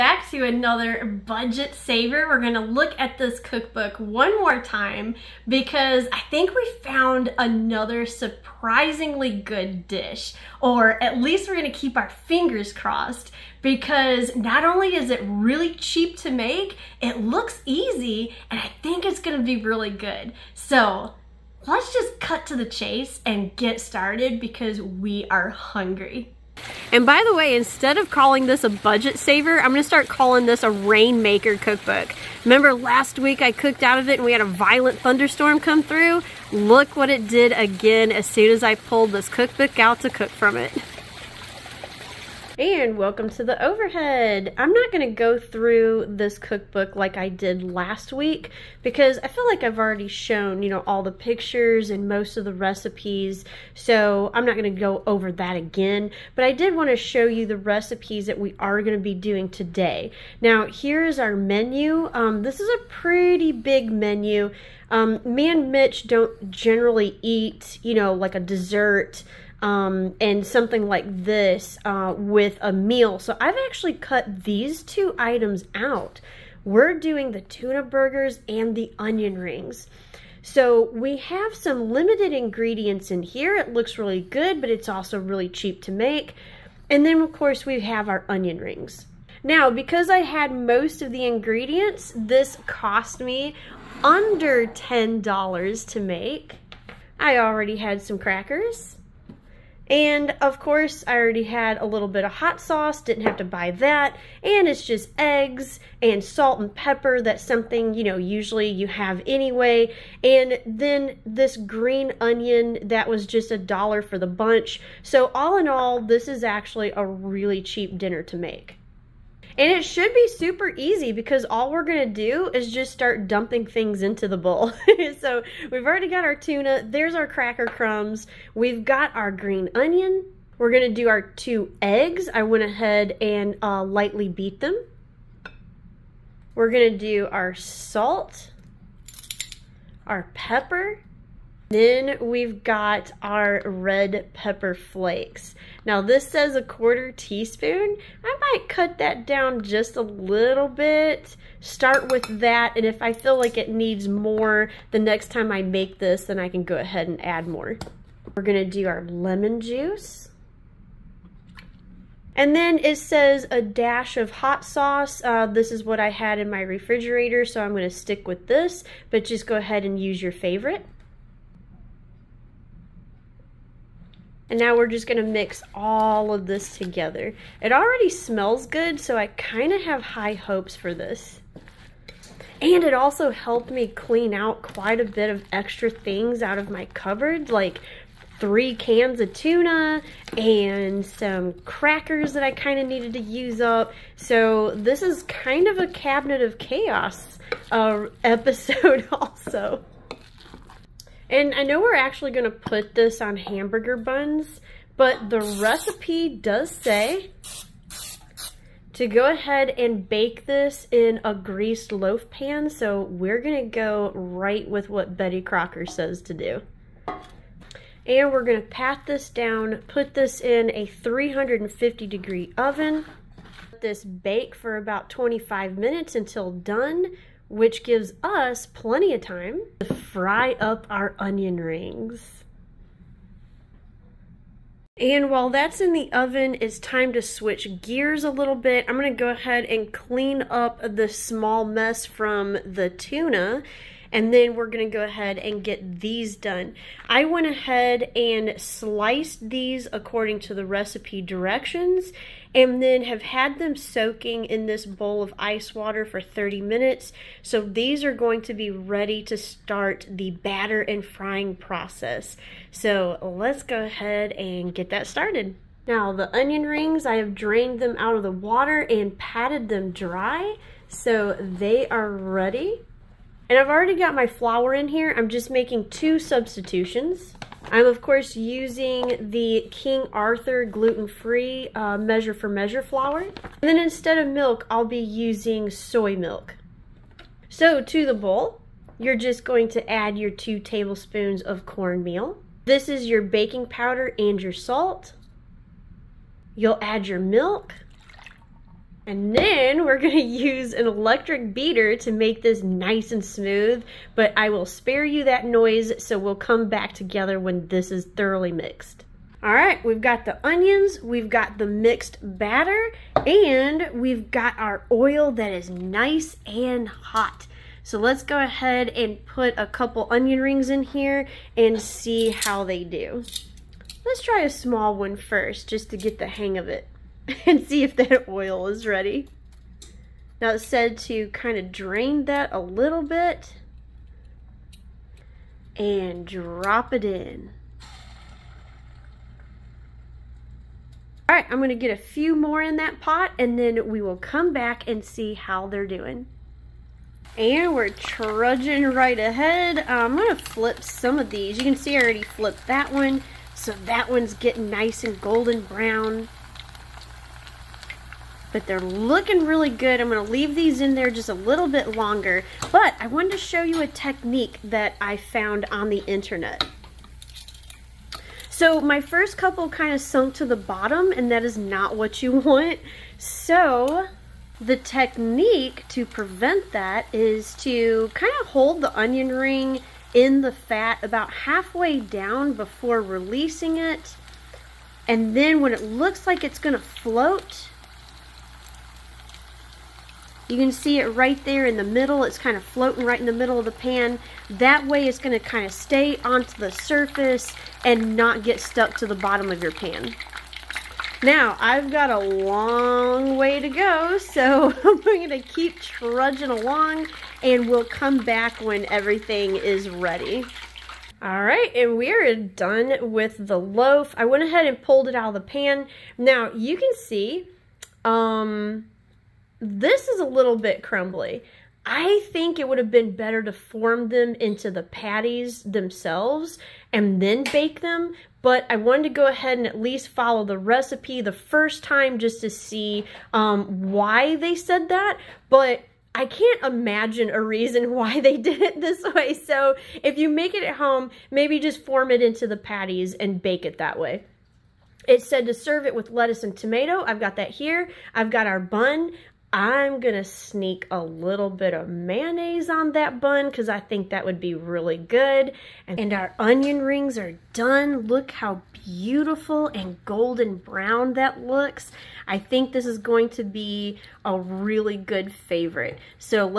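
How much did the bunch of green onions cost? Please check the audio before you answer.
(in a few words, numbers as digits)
a dollar.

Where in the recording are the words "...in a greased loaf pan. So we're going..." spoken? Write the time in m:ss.
3:30.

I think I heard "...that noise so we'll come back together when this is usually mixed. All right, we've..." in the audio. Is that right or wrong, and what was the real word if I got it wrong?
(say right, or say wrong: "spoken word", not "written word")
wrong: "thoroughly", not "usually".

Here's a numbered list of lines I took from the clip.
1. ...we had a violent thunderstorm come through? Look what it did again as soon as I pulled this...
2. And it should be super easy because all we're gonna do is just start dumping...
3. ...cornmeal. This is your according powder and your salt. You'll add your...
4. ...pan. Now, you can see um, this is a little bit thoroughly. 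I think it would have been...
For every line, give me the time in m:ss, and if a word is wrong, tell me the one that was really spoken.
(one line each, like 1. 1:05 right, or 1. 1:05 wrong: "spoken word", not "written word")
1. 0:34 right
2. 1:59 right
3. 4:51 wrong: "baking", not "according"
4. 6:55 wrong: "crumbly", not "thoroughly".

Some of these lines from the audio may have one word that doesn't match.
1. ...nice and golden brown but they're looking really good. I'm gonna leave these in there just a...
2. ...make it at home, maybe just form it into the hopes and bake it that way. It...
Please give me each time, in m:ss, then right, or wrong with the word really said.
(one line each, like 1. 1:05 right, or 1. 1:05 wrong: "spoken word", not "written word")
1. 5:54 right
2. 7:20 wrong: "patties", not "hopes".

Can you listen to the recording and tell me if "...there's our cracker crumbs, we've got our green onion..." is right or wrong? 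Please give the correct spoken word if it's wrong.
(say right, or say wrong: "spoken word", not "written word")
right.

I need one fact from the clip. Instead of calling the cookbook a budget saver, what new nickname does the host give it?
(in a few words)
rainmaker cookbook.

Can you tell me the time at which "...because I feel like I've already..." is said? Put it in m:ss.
0:48.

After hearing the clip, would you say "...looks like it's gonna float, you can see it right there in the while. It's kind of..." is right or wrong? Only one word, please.
wrong.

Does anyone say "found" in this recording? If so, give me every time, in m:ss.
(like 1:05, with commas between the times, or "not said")
0:06, 6:05.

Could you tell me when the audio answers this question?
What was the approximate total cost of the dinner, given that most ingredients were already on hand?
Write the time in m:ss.
1:34.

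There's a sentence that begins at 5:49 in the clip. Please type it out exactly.
I'm gonna flip some of these.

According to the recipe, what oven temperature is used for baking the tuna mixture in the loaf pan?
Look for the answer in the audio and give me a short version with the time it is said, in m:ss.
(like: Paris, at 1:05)
350 degrees, at 3:40.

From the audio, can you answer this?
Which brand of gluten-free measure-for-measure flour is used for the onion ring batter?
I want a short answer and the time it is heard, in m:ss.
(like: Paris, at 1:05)
King Arthur, at 4:39.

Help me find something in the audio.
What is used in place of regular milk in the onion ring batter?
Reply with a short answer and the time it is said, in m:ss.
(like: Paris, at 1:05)
soy milk, at 4:45.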